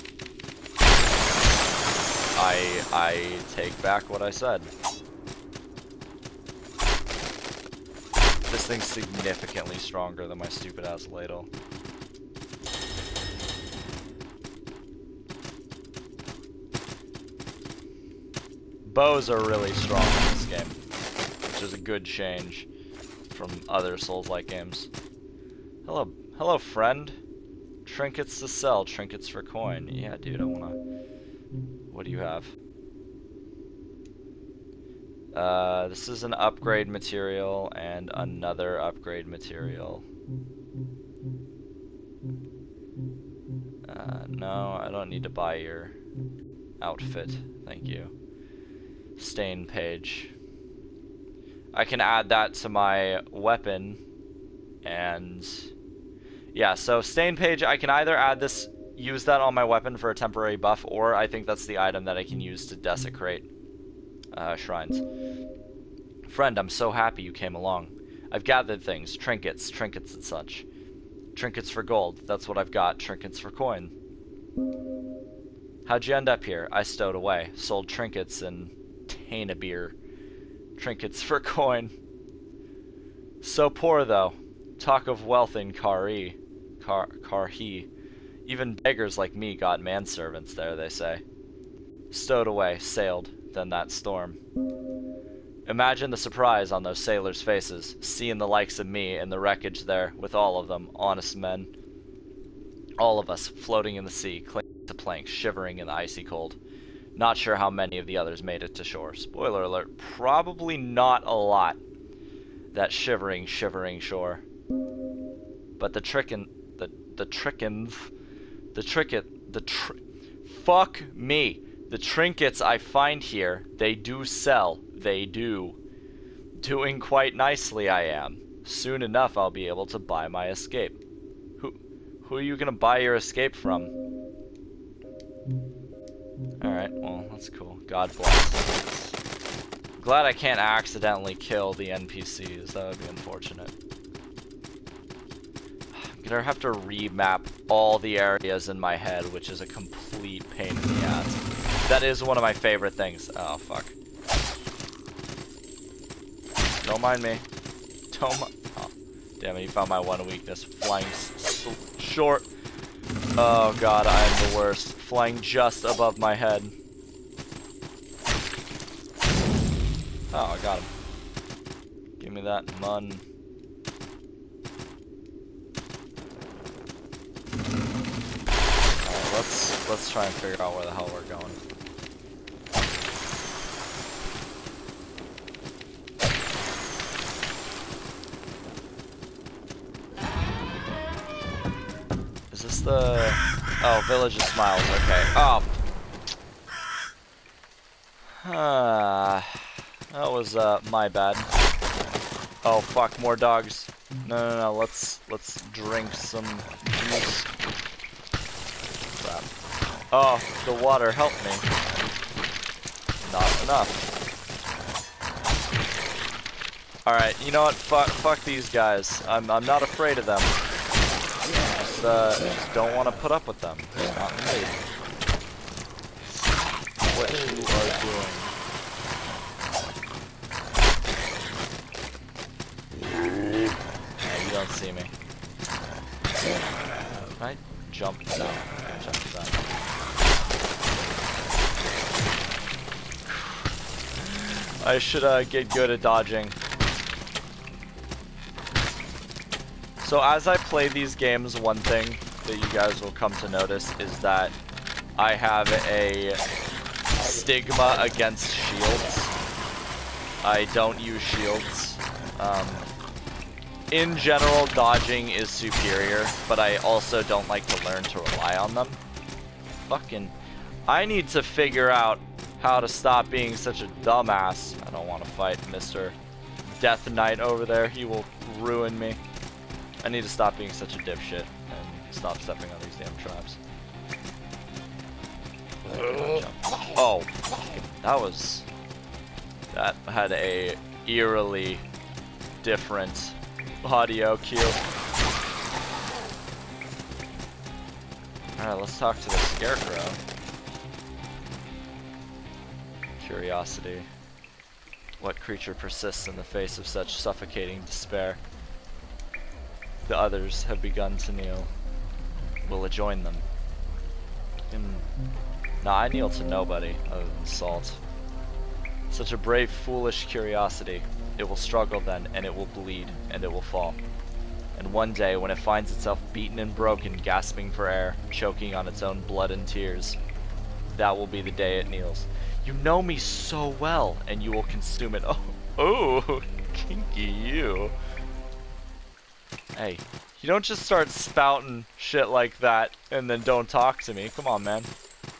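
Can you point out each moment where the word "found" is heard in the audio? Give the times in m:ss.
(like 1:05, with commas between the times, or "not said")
2:39.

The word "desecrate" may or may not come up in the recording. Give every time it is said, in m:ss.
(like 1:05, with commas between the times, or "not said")
1:02.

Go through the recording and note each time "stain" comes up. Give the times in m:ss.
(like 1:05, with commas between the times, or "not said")
0:49, 0:57.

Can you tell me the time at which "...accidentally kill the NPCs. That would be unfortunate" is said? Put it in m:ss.
2:20.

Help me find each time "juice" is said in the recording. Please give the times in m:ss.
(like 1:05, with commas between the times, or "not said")
3:26.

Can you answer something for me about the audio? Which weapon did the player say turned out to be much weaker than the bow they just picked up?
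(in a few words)
Ladle.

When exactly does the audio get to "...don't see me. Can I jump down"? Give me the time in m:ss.
3:54.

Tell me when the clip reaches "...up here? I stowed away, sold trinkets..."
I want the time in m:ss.
1:16.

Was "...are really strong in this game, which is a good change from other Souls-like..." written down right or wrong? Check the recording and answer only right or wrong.
right.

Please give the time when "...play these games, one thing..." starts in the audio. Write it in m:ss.
4:10.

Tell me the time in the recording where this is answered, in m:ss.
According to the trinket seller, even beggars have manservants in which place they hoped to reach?
1:27.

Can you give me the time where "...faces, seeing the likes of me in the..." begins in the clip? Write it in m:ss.
1:37.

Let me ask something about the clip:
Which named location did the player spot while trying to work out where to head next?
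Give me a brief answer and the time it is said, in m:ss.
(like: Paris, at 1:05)
Village of Smiles, at 3:14.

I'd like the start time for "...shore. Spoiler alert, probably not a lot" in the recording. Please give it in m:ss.
1:48.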